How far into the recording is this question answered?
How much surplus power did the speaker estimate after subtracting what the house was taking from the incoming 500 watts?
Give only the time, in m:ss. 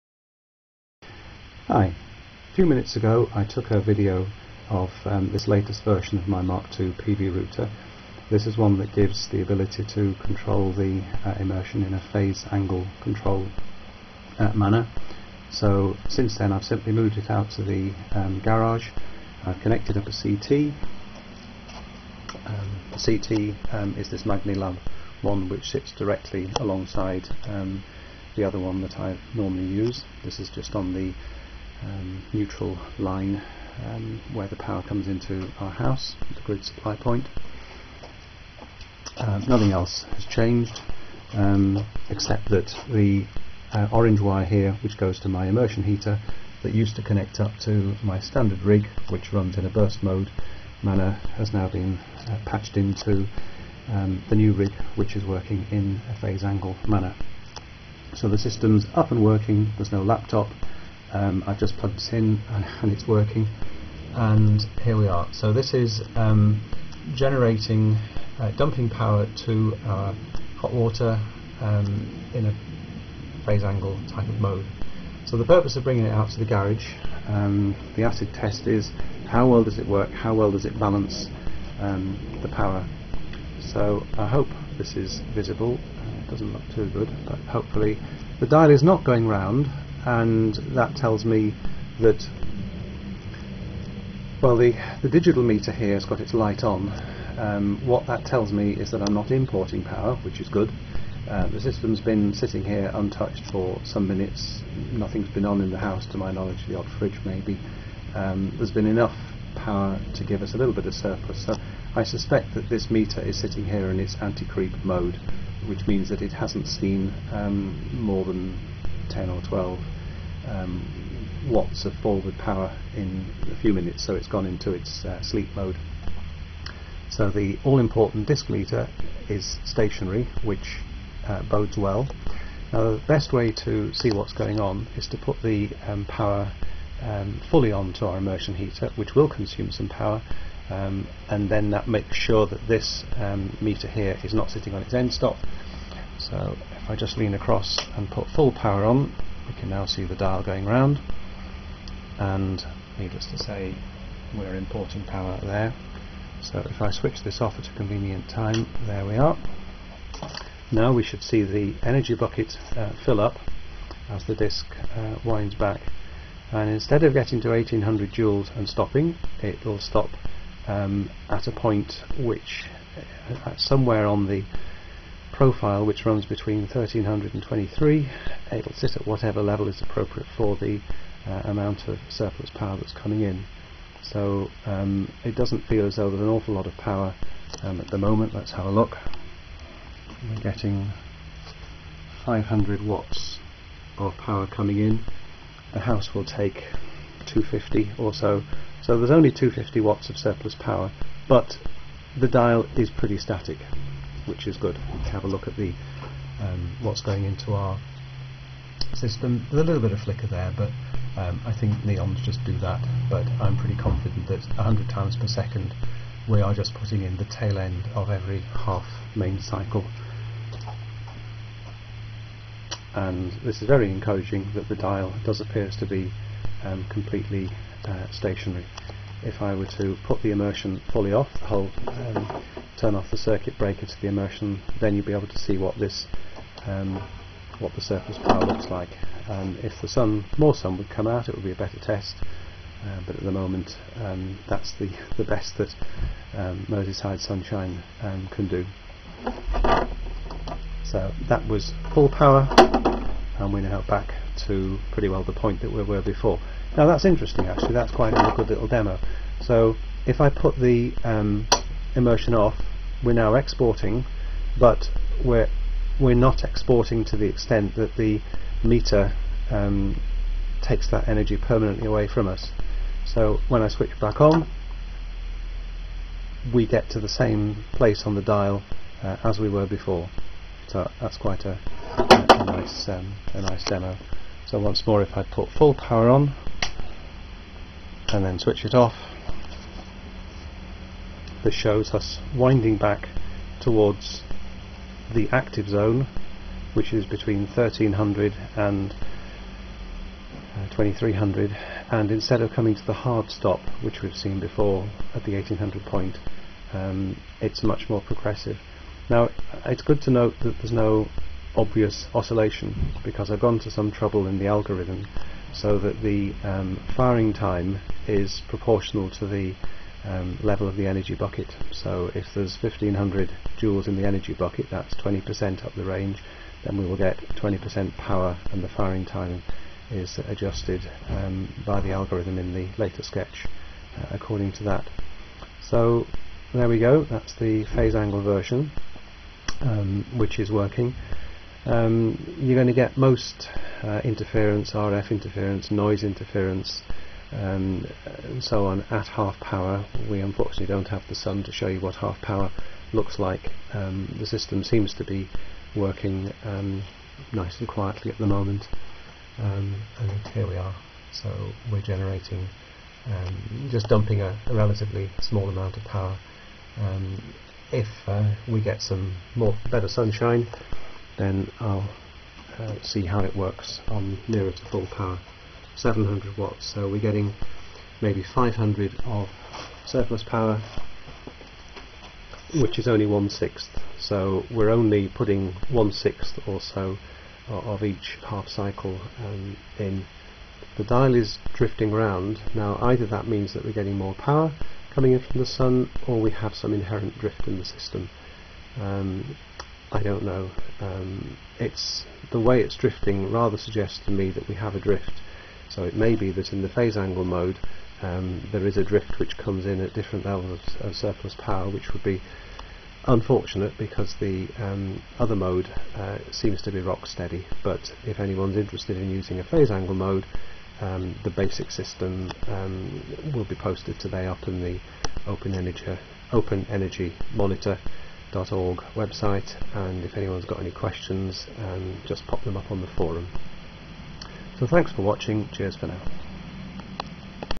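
3:19.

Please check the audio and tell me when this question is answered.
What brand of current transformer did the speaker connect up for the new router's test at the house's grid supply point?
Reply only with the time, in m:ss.
0:24.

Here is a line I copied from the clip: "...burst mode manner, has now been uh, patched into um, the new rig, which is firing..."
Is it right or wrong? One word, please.
wrong.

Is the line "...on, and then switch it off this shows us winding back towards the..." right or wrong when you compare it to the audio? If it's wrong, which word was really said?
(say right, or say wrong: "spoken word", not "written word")
right.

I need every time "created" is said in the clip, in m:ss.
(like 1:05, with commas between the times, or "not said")
not said.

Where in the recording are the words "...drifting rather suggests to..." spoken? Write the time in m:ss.
6:42.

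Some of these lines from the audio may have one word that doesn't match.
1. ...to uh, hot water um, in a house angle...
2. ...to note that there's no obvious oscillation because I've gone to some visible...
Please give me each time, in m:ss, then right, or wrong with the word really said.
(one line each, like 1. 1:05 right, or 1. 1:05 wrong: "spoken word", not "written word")
1. 1:09 wrong: "phase", not "house"
2. 5:10 wrong: "trouble", not "visible".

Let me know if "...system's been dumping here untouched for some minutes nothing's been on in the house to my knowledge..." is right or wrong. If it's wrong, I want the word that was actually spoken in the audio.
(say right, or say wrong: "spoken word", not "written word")
wrong: "sitting", not "dumping".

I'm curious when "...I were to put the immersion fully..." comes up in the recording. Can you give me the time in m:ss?
3:49.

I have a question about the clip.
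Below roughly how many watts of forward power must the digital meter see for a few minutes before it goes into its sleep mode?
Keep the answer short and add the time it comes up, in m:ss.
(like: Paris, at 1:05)
10 or 12 watts, at 1:59.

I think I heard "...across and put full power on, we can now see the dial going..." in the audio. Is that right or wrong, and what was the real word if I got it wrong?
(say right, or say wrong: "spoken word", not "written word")
right.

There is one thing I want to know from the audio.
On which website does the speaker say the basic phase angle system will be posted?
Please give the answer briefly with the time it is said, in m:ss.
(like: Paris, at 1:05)
Open Energy Monitor, at 7:06.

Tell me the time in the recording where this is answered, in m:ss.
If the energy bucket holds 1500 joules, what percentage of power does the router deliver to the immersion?
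5:27.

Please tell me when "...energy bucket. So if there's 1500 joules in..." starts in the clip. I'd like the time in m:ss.
5:20.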